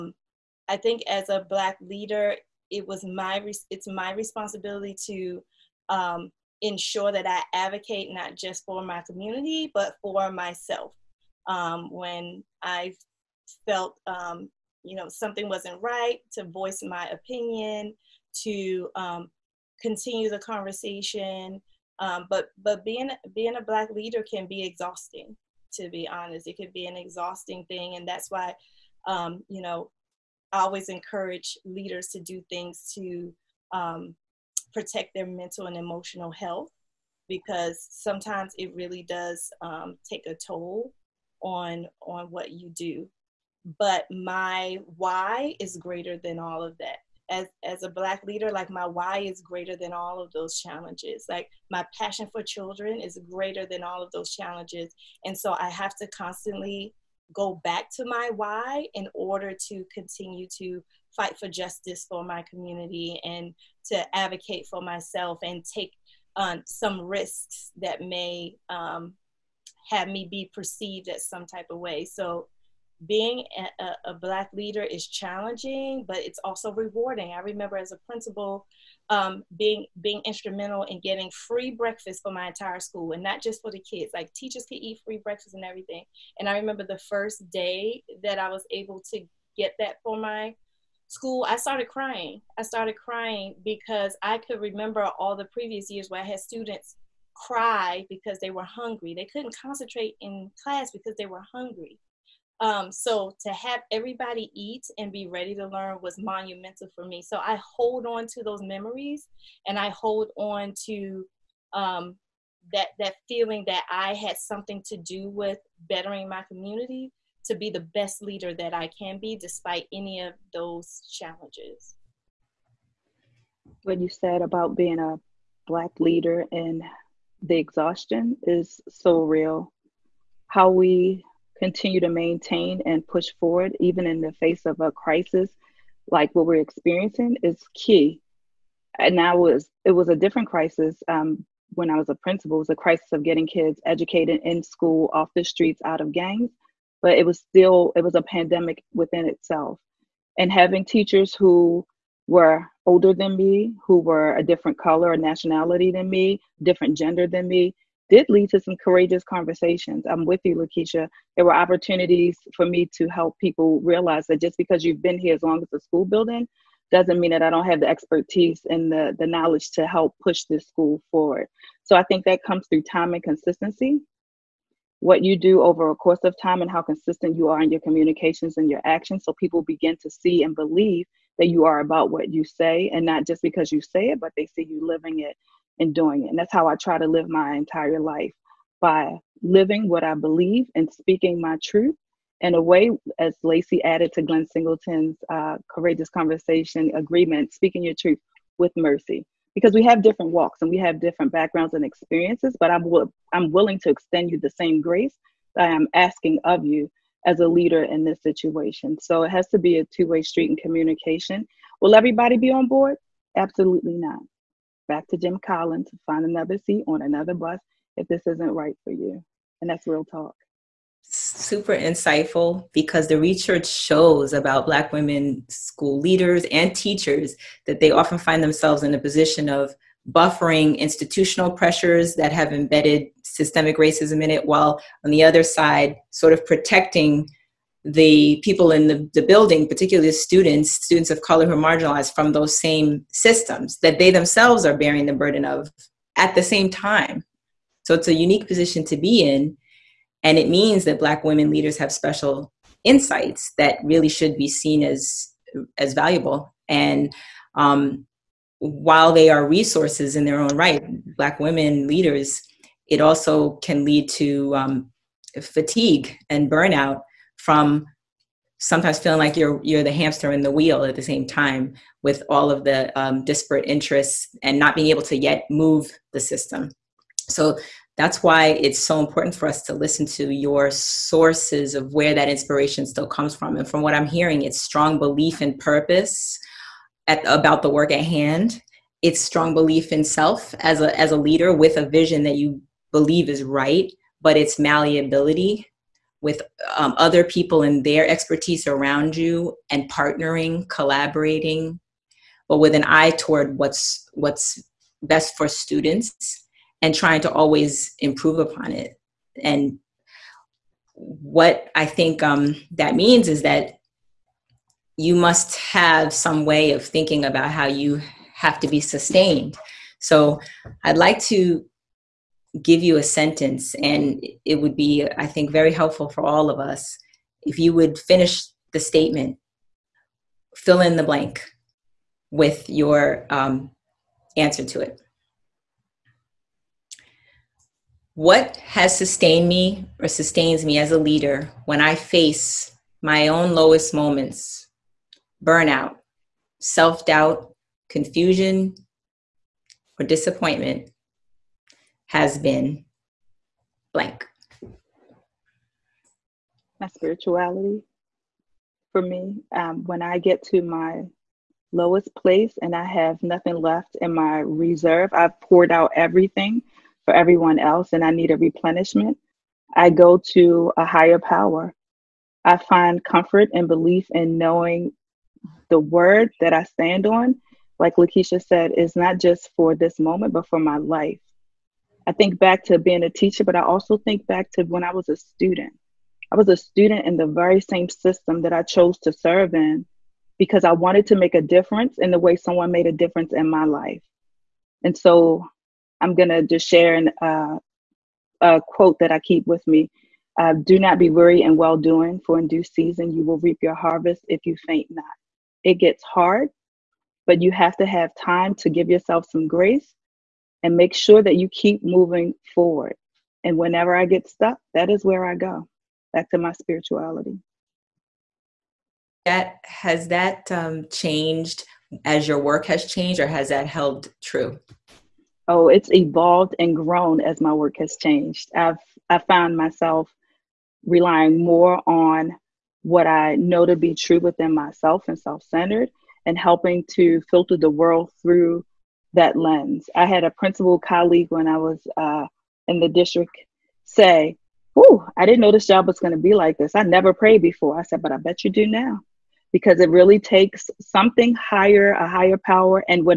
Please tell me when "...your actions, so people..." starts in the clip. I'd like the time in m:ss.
2:58.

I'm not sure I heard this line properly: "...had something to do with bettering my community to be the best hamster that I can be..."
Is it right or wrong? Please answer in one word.
wrong.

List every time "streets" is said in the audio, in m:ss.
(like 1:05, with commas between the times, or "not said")
2:25, 3:30.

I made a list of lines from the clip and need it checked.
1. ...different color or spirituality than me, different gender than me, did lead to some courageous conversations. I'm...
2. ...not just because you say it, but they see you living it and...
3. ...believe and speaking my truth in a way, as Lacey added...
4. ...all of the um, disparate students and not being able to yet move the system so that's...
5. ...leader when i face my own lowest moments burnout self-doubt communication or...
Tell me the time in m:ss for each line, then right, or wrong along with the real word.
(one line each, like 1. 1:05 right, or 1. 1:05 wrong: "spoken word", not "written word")
1. 2:34 wrong: "nationality", not "spirituality"
2. 3:03 right
3. 3:10 right
4. 4:32 wrong: "interests", not "students"
5. 5:40 wrong: "confusion", not "communication".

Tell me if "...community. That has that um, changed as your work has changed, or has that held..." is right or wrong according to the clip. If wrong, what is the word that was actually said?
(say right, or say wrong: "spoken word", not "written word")
wrong: "spirituality", not "community".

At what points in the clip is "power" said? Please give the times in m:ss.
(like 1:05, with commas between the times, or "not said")
6:11, 7:32.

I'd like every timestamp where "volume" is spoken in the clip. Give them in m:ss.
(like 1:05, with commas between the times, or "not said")
not said.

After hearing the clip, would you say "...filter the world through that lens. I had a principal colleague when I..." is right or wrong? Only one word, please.
right.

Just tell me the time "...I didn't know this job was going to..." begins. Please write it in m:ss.
7:25.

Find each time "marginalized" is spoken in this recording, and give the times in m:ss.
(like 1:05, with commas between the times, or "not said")
4:01.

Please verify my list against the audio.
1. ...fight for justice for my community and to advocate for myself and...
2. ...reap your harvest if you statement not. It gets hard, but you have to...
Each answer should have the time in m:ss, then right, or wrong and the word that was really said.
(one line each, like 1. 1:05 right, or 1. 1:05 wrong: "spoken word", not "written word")
1. 1:01 right
2. 6:43 wrong: "faint", not "statement".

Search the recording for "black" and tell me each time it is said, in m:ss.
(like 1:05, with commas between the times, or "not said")
0:01, 0:23, 0:47, 1:14, 2:05, 3:44, 4:10, 4:21.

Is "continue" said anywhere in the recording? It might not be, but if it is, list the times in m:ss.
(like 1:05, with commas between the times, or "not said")
0:19, 0:59, 2:11.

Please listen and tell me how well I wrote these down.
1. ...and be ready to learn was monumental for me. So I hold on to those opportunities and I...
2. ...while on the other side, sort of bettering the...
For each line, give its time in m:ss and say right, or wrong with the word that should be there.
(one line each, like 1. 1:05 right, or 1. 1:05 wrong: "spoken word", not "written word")
1. 1:44 wrong: "memories", not "opportunities"
2. 3:54 wrong: "protecting", not "bettering".